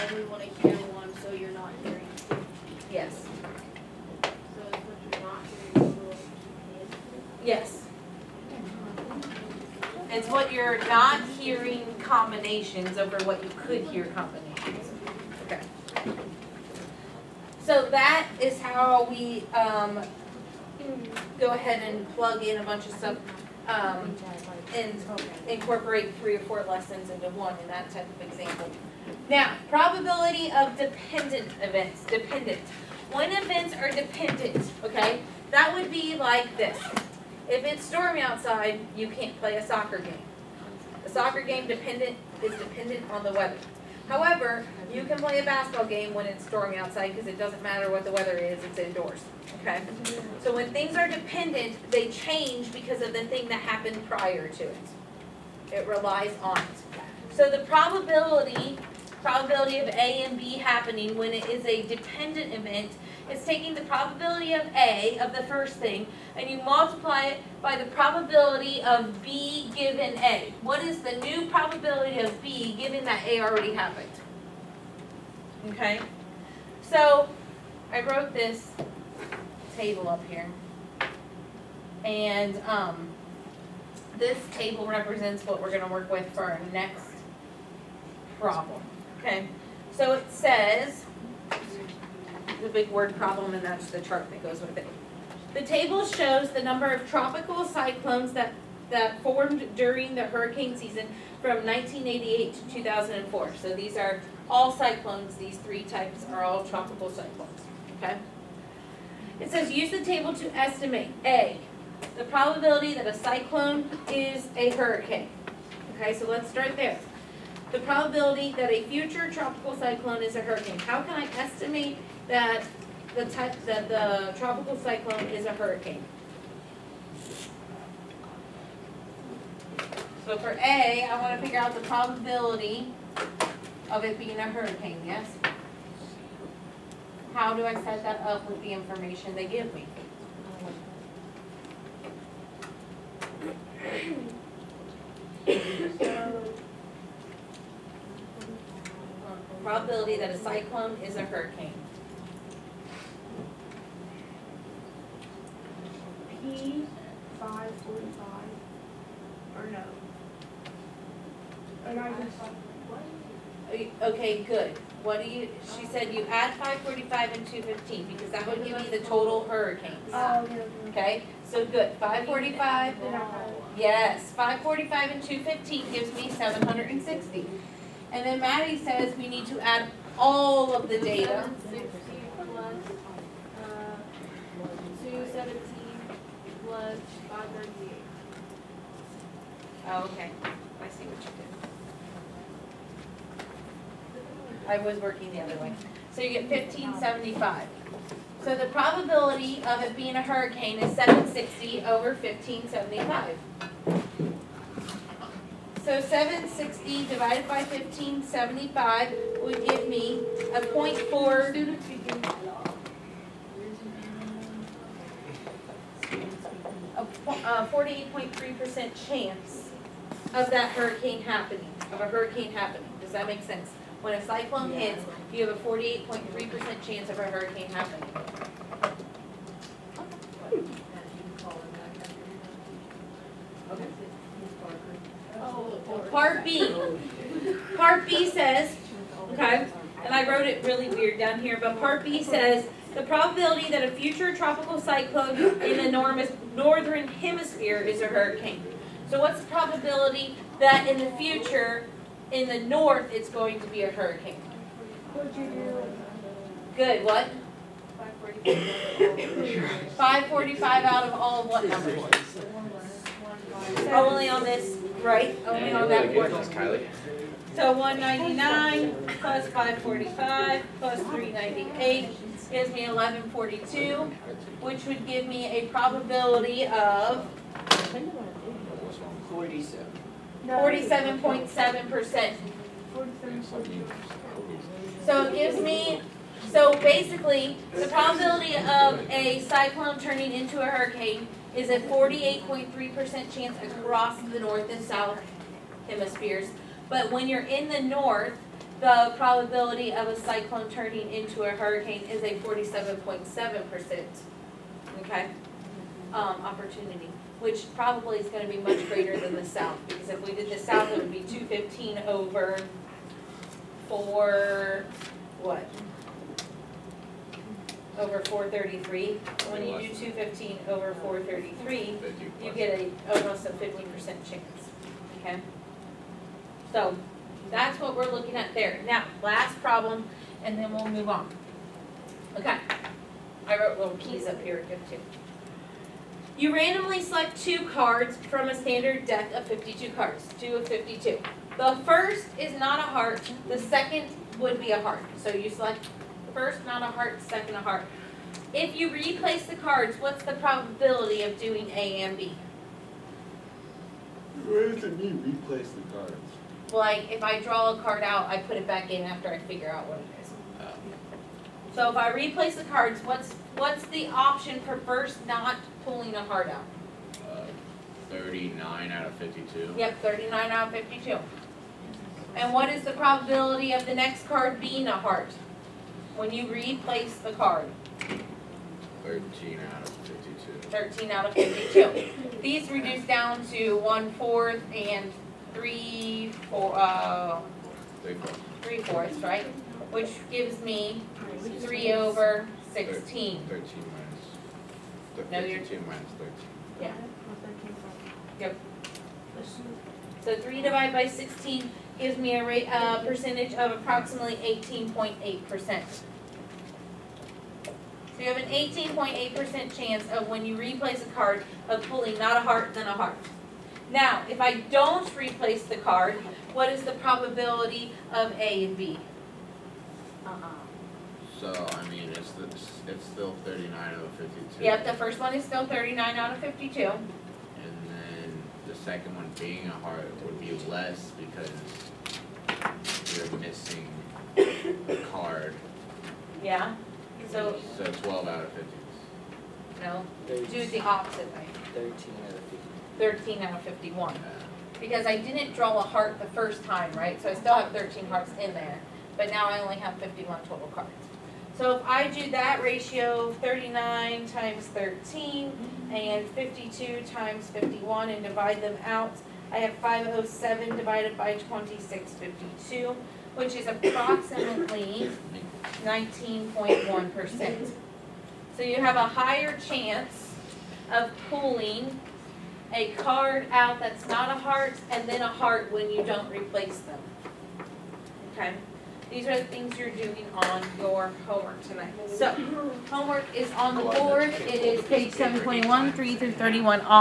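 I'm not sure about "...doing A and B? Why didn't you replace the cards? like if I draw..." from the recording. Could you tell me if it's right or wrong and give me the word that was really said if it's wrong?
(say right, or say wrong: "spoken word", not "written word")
right.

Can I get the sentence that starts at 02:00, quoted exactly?
How can I estimate that the that the tropical cyclone is a hurricane?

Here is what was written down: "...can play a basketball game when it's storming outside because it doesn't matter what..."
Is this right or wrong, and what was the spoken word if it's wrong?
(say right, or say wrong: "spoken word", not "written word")
right.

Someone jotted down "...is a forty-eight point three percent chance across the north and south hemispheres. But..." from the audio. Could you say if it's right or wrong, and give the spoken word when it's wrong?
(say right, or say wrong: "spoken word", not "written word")
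right.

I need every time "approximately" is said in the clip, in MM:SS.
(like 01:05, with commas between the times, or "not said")
06:43, 07:43.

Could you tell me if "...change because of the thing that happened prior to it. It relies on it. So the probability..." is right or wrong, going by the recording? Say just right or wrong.
right.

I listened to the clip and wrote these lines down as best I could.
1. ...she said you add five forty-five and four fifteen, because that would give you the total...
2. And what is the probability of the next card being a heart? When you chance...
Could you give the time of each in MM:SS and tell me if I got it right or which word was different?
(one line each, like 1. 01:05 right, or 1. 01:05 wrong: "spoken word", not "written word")
1. 02:45 wrong: "two", not "four"
2. 06:12 wrong: "replace", not "chance".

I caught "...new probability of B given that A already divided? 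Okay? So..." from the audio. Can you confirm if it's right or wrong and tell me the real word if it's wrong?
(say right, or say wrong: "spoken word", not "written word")
wrong: "happened", not "divided".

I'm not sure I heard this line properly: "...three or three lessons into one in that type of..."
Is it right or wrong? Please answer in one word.
wrong.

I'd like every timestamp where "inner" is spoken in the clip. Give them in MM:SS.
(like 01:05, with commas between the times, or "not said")
not said.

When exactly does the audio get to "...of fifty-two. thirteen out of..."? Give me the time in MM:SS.
06:19.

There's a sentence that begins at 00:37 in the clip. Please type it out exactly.
If it's stormy outside, you can't play a soccer game.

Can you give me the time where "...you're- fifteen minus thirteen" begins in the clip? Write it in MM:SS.
06:35.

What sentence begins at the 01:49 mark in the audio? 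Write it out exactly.
It says use the table to estimate A, the probability that a cyclone is a hurricane.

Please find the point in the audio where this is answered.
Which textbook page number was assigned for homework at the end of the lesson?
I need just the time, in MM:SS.
08:05.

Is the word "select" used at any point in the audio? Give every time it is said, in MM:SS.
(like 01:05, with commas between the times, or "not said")
05:37, 05:45.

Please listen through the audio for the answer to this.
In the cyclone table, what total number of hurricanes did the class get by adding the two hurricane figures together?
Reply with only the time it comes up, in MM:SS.
02:56.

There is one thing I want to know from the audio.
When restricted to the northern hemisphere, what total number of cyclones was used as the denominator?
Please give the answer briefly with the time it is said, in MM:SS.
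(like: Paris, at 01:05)
1142, at 04:32.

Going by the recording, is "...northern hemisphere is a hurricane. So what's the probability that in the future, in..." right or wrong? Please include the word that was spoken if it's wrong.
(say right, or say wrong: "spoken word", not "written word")
right.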